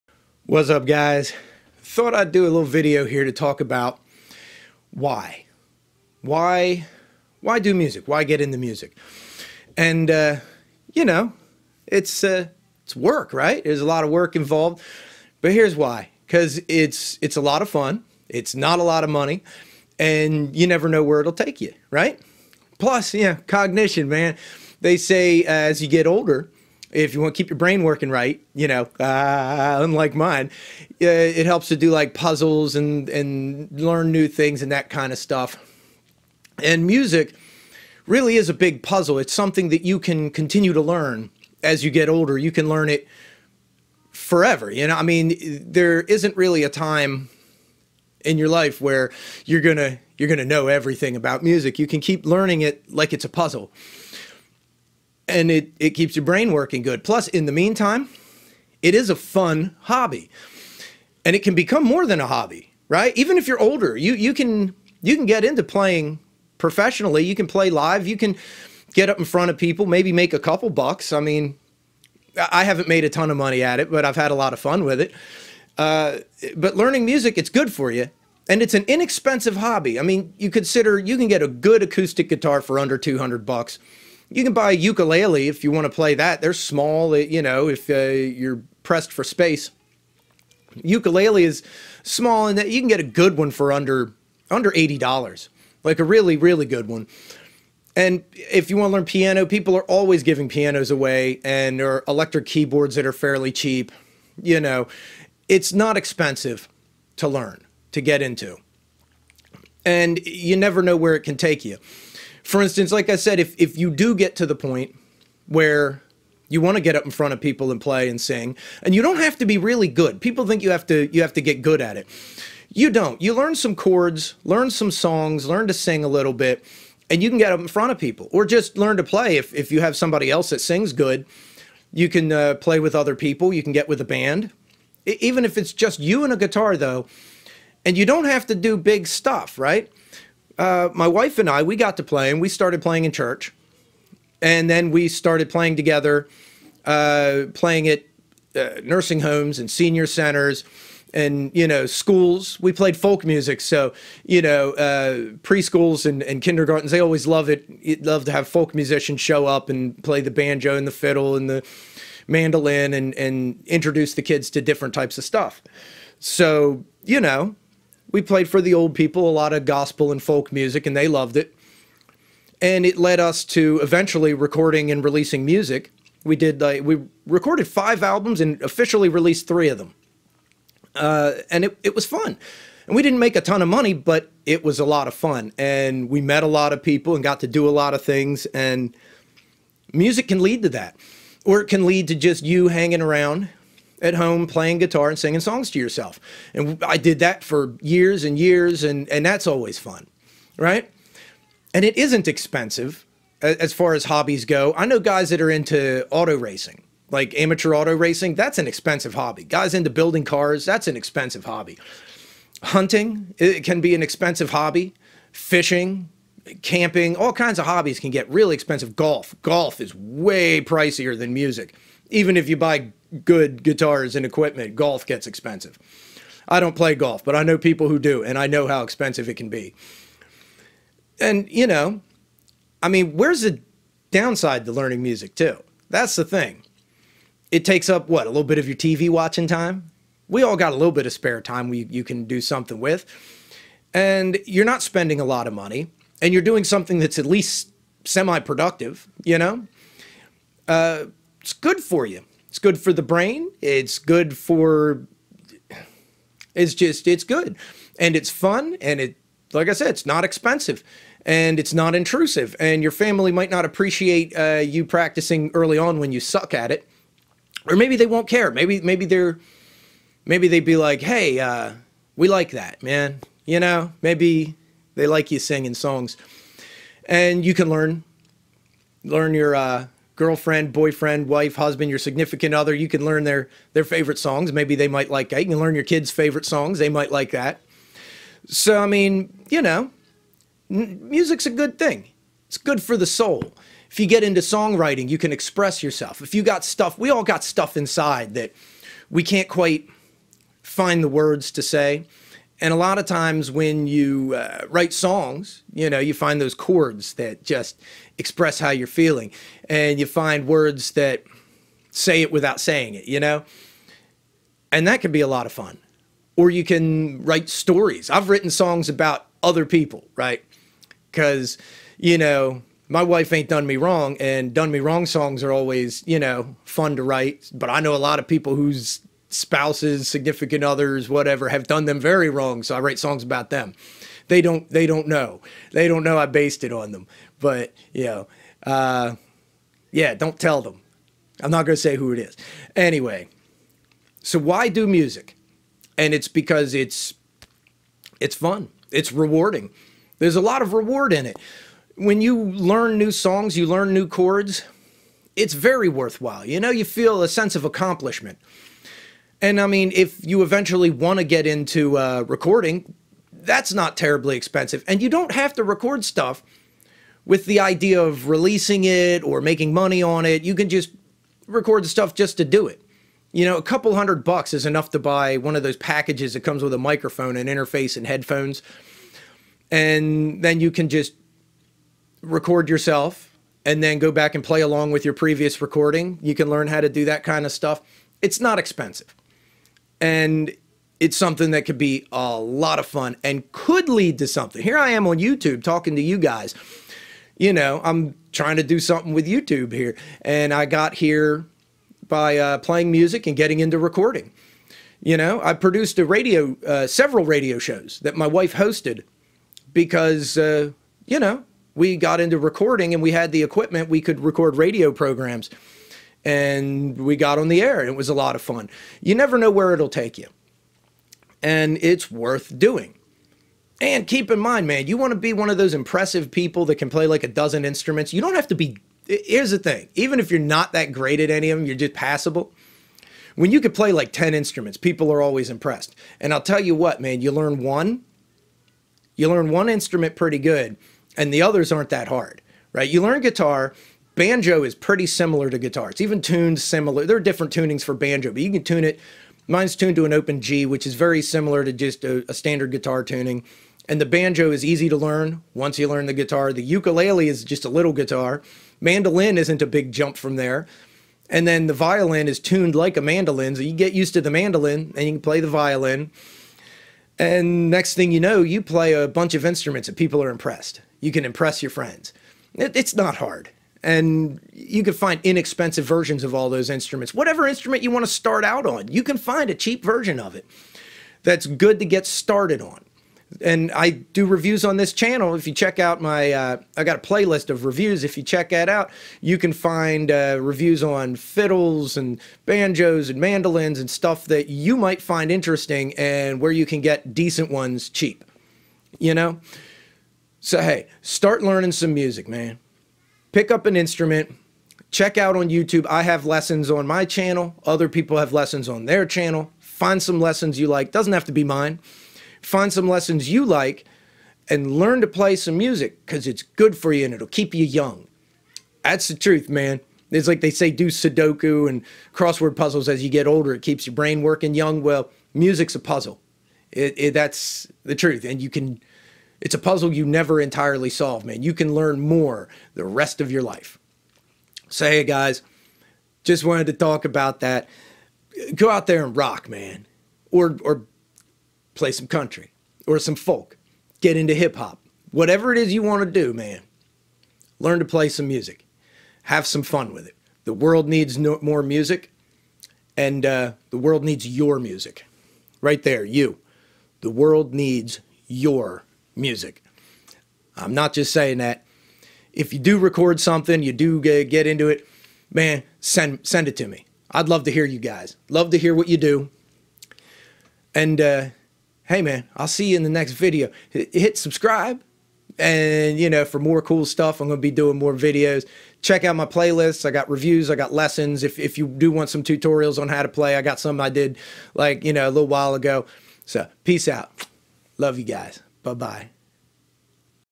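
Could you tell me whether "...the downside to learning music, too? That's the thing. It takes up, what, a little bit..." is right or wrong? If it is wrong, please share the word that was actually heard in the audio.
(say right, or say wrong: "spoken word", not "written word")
right.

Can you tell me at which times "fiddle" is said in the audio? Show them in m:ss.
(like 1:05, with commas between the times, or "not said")
2:40, 8:11.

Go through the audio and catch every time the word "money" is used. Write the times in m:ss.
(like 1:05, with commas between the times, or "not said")
0:19, 1:13, 3:03, 4:05, 6:09.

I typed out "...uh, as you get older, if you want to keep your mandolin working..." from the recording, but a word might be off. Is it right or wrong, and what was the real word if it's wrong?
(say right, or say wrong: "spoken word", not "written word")
wrong: "brain", not "mandolin".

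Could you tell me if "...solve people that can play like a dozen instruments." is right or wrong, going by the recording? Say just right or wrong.
wrong.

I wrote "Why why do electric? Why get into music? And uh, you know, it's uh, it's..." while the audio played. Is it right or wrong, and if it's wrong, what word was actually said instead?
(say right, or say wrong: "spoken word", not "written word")
wrong: "music", not "electric".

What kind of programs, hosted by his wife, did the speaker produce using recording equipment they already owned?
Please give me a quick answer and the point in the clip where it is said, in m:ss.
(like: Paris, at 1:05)
radio shows, at 6:47.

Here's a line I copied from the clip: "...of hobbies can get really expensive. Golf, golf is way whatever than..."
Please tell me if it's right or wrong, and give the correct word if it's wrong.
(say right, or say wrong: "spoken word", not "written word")
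wrong: "pricier", not "whatever".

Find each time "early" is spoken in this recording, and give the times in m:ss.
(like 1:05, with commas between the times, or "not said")
4:25.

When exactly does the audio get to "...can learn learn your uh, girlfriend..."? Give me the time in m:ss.
4:37.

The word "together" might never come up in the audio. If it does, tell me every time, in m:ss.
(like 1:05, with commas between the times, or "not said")
2:25.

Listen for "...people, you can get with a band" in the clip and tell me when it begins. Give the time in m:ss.
2:13.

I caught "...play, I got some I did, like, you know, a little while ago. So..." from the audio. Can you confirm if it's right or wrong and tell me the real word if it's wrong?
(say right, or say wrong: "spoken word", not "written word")
right.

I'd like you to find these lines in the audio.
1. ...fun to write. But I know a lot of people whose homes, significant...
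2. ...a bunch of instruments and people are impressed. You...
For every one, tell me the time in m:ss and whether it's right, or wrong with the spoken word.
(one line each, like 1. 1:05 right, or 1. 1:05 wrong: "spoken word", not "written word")
1. 5:26 wrong: "spouses", not "homes"
2. 7:48 right.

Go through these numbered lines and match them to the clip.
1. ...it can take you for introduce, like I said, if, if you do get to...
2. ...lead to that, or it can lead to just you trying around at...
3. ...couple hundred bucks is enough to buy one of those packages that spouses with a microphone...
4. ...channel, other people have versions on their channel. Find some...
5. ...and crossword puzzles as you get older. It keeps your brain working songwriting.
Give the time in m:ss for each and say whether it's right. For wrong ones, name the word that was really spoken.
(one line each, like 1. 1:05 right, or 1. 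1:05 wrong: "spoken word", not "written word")
1. 1:51 wrong: "instance", not "introduce"
2. 3:10 wrong: "hanging", not "trying"
3. 6:13 wrong: "comes", not "spouses"
4. 8:27 wrong: "lessons", not "versions"
5. 8:41 wrong: "young", not "songwriting".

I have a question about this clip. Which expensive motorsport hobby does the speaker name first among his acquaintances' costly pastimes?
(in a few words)
amateur auto racing.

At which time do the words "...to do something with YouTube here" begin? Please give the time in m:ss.
6:38.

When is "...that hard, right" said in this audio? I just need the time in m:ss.
7:21.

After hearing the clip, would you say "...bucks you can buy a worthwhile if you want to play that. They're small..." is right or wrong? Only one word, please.
wrong.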